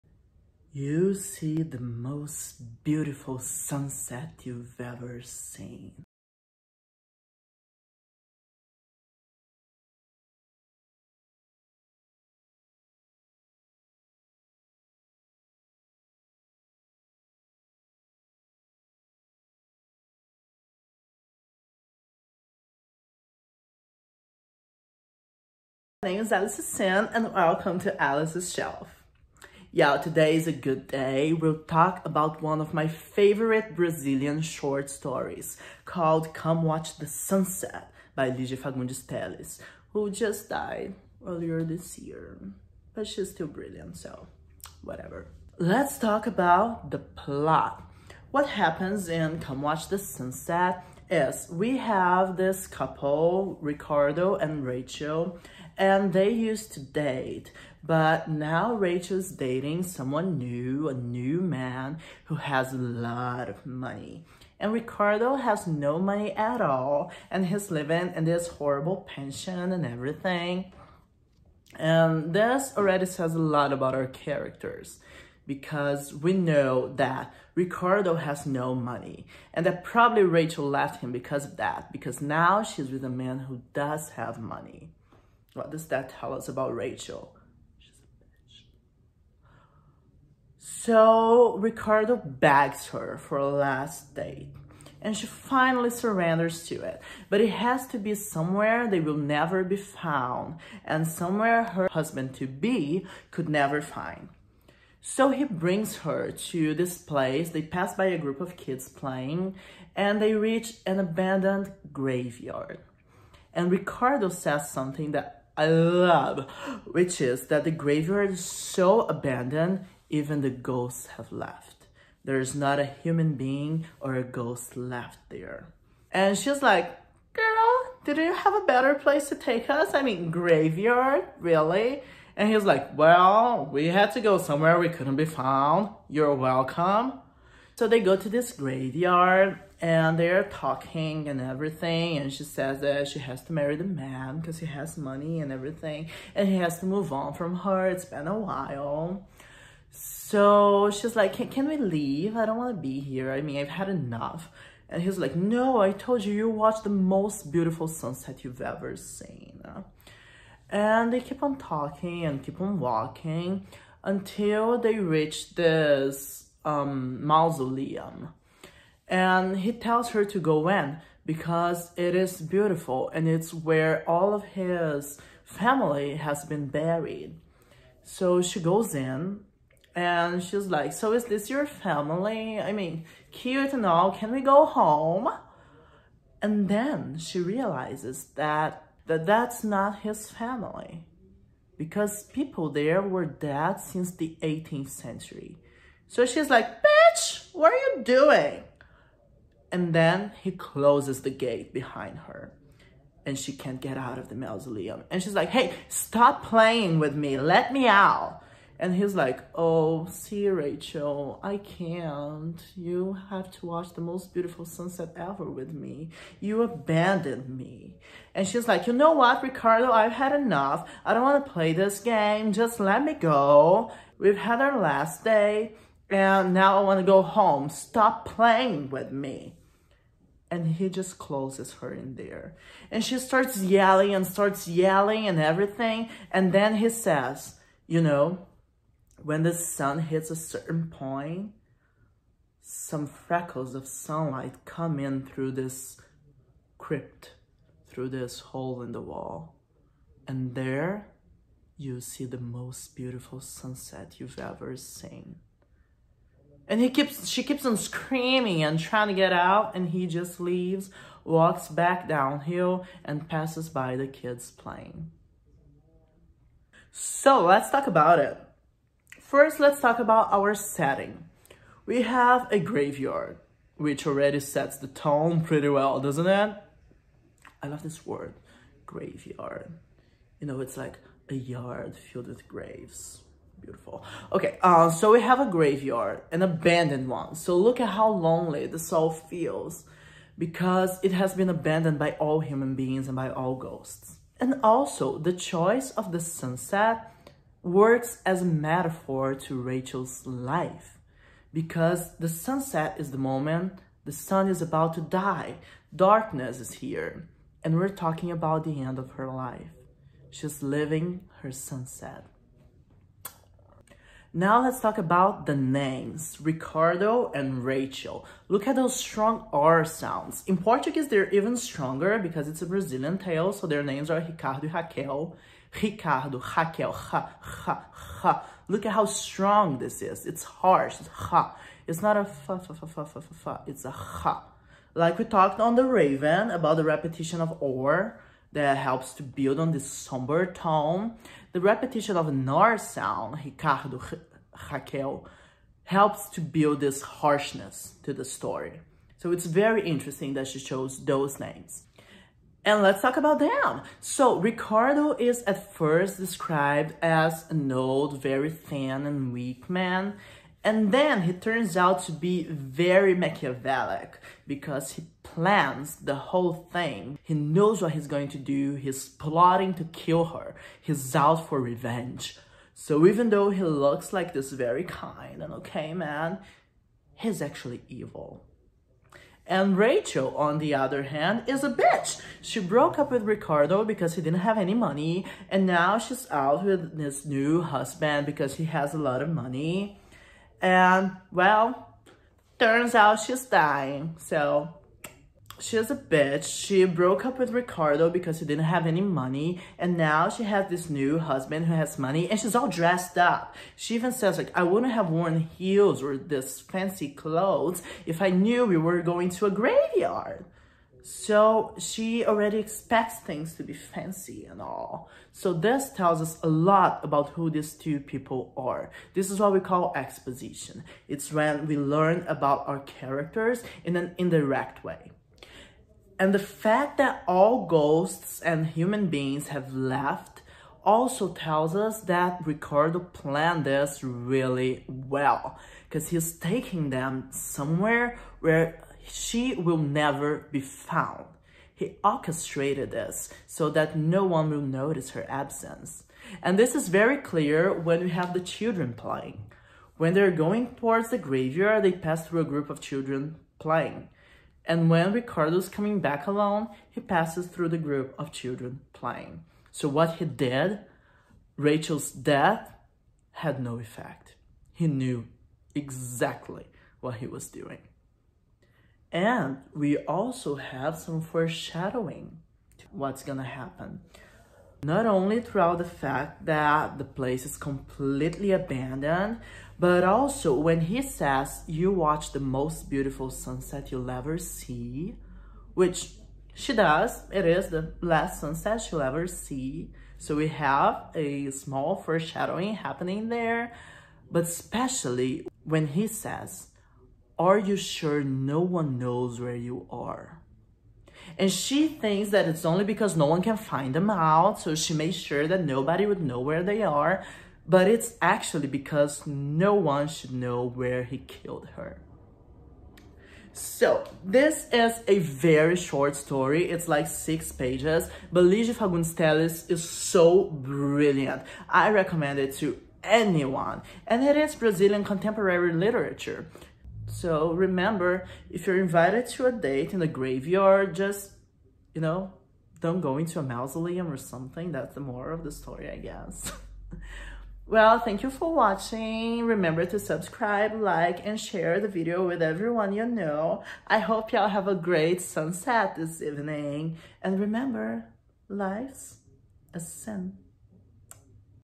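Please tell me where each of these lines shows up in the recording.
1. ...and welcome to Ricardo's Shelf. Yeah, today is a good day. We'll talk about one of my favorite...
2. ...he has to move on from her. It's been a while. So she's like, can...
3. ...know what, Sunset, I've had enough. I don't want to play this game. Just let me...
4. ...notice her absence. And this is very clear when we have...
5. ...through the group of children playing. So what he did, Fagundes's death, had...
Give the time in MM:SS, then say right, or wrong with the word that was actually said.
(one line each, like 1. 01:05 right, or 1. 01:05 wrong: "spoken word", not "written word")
1. 00:27 wrong: "Alice", not "Ricardo"
2. 02:26 right
3. 03:38 wrong: "Ricardo", not "Sunset"
4. 07:24 right
5. 07:37 wrong: "Rachel", not "Fagundes".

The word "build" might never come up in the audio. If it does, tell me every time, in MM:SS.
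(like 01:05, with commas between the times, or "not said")
05:39, 05:46.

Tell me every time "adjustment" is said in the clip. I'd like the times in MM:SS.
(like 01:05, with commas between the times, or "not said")
not said.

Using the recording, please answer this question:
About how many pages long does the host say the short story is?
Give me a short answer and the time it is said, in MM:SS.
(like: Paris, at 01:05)
6, at 08:37.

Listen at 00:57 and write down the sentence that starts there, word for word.
But now Rachel's dating someone new, a new man who has a lot of money.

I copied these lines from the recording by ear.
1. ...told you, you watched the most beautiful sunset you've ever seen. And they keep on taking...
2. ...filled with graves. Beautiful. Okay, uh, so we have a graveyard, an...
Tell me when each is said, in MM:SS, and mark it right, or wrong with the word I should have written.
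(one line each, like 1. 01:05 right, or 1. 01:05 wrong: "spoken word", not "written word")
1. 02:35 wrong: "talking", not "taking"
2. 04:41 right.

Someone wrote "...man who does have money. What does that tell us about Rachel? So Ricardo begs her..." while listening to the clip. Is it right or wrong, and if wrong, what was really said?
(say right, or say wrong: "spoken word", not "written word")
right.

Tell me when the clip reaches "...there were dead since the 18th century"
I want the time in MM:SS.
03:12.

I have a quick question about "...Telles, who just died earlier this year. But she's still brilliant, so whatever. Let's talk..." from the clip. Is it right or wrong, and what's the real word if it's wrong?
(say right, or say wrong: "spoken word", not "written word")
right.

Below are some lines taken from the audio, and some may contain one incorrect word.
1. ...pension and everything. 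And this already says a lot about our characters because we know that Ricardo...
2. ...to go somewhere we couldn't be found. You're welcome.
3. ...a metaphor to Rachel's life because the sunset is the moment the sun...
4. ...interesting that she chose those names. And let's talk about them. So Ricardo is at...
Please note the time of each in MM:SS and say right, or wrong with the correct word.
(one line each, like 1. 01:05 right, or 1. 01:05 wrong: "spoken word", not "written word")
1. 01:09 right
2. 02:14 right
3. 04:58 right
4. 05:49 right.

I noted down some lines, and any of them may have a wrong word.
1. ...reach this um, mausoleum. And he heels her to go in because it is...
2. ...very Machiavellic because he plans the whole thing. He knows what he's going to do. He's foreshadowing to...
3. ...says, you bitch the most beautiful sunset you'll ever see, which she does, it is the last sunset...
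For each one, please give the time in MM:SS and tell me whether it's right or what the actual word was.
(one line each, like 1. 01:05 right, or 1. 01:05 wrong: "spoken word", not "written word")
1. 02:44 wrong: "tells", not "heels"
2. 06:02 wrong: "plotting", not "foreshadowing"
3. 08:01 wrong: "watch", not "bitch".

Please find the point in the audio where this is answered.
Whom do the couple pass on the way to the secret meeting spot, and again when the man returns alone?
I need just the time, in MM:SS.
01:48.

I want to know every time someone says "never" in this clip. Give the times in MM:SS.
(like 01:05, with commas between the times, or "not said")
01:39, 01:43, 07:19.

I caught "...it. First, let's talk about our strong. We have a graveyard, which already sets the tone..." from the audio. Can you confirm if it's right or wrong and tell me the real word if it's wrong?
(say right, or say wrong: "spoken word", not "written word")
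wrong: "setting", not "strong".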